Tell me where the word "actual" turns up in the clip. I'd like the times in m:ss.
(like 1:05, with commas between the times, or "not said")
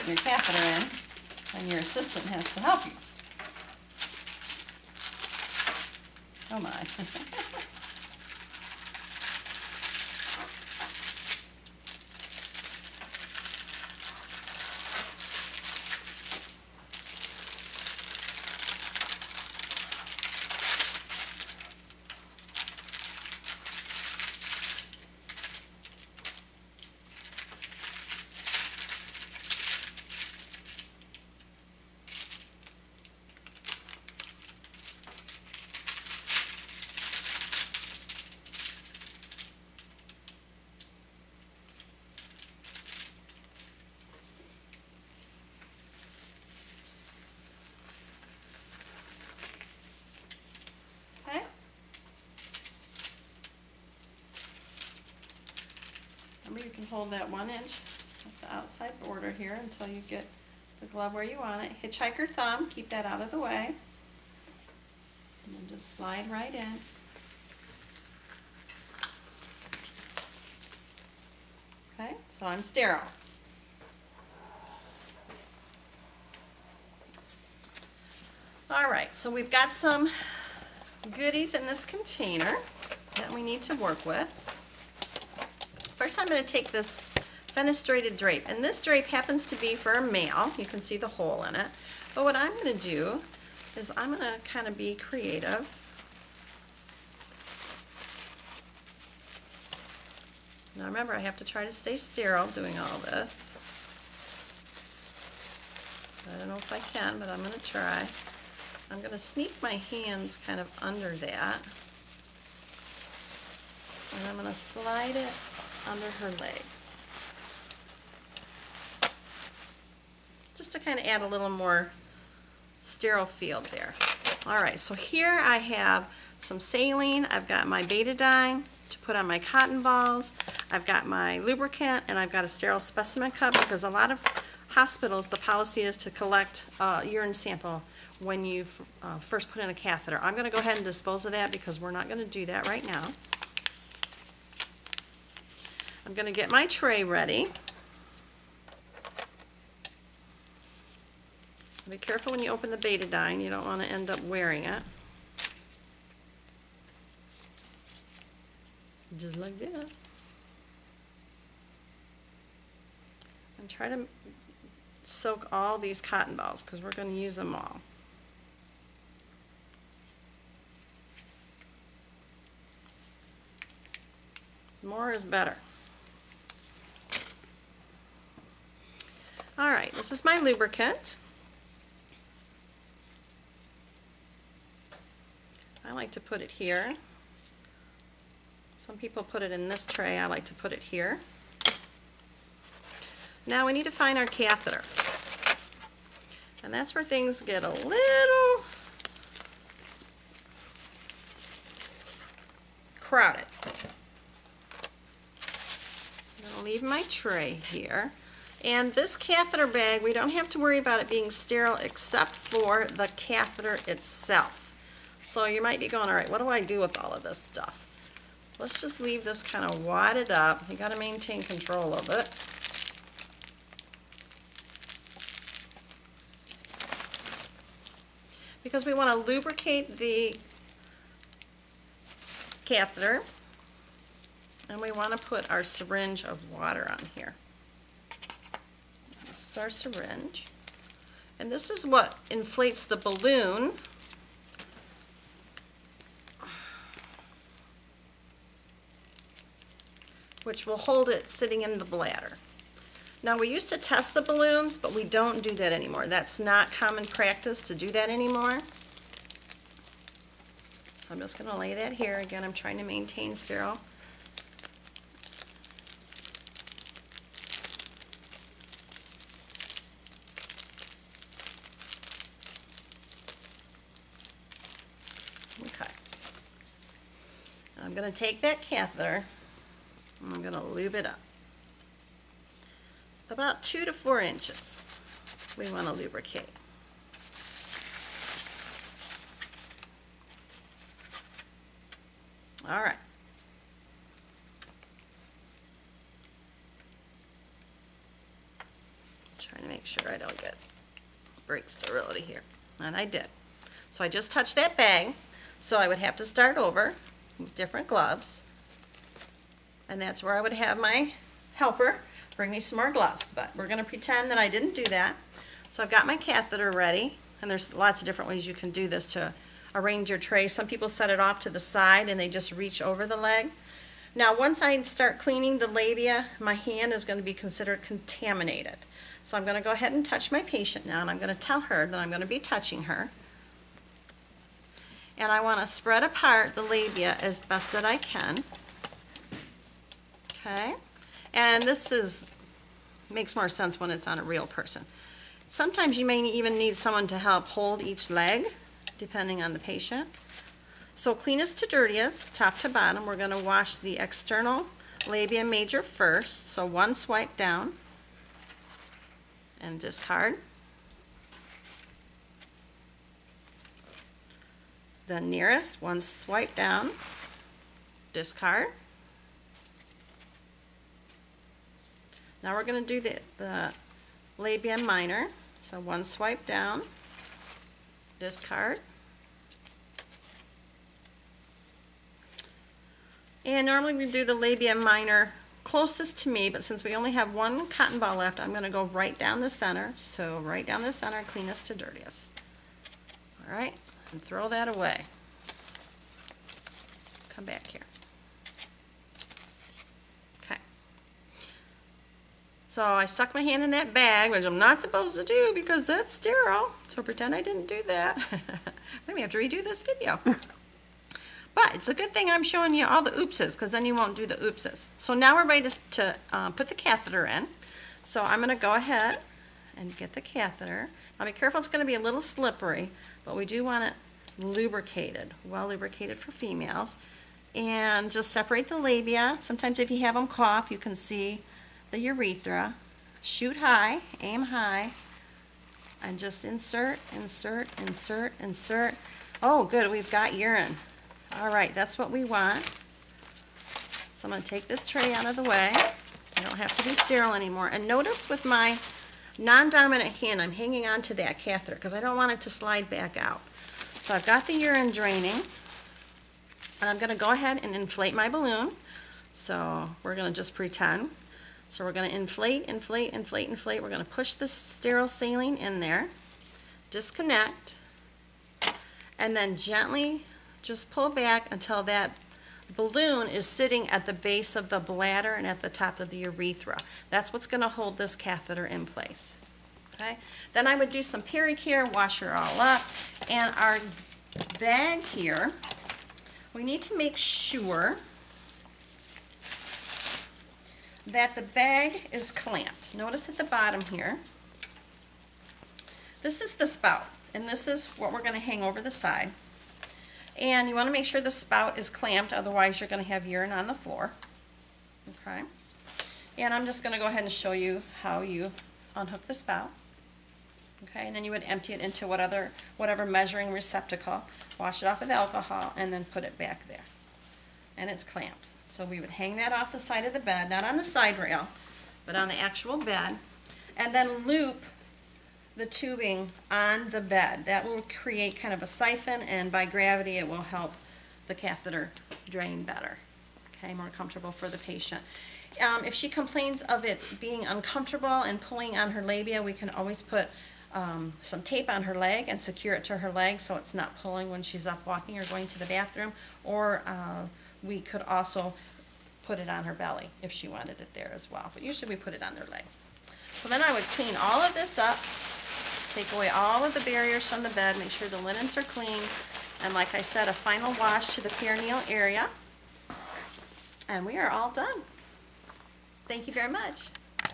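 8:42.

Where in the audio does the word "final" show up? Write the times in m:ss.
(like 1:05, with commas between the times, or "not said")
9:20.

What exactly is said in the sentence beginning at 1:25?
First, I'm going to take this fenestrated drape.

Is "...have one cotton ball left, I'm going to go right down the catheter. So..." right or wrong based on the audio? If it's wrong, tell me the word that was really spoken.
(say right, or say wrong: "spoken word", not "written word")
wrong: "center", not "catheter".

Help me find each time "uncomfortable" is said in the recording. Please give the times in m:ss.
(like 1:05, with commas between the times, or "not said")
8:57.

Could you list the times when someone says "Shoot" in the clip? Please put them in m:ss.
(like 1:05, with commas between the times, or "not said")
7:13.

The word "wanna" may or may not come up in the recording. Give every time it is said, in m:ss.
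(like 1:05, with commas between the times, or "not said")
3:48, 3:54.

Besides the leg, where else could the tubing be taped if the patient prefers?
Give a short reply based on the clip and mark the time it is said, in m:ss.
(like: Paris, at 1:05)
Her belly, at 9:09.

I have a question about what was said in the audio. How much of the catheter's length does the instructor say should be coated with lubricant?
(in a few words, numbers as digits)
2 to 4 inches.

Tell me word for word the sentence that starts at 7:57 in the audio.
That's what's going to hold this catheter in place.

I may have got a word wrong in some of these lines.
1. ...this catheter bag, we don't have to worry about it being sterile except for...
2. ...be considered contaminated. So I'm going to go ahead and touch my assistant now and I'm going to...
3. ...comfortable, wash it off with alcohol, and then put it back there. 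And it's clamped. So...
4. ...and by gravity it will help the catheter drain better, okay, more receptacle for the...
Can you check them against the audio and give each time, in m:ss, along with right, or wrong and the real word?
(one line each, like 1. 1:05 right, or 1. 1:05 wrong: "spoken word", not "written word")
1. 3:28 right
2. 5:27 wrong: "patient", not "assistant"
3. 8:33 wrong: "receptacle", not "comfortable"
4. 8:49 wrong: "comfortable", not "receptacle".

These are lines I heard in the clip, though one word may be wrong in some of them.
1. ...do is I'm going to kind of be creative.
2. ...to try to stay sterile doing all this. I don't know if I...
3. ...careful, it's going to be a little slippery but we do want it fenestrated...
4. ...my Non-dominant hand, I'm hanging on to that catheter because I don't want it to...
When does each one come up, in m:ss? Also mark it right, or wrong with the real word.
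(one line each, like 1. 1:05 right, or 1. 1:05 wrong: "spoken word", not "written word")
1. 1:32 right
2. 1:41 right
3. 7:01 wrong: "lubricated", not "fenestrated"
4. 7:28 right.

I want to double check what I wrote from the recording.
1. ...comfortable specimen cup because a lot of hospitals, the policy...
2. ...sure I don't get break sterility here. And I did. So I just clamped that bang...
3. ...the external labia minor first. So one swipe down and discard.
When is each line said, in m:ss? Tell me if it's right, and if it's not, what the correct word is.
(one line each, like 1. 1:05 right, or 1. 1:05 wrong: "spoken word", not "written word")
1. 2:12 wrong: "sterile", not "comfortable"
2. 4:59 wrong: "touched", not "clamped"
3. 5:53 wrong: "major", not "minor".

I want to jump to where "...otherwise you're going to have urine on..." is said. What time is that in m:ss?
8:22.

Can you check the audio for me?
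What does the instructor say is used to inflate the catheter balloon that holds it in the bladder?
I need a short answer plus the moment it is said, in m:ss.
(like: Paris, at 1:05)
Syringe of water, at 3:55.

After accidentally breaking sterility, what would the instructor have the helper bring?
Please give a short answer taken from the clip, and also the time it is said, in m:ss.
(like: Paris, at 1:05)
More gloves, at 5:12.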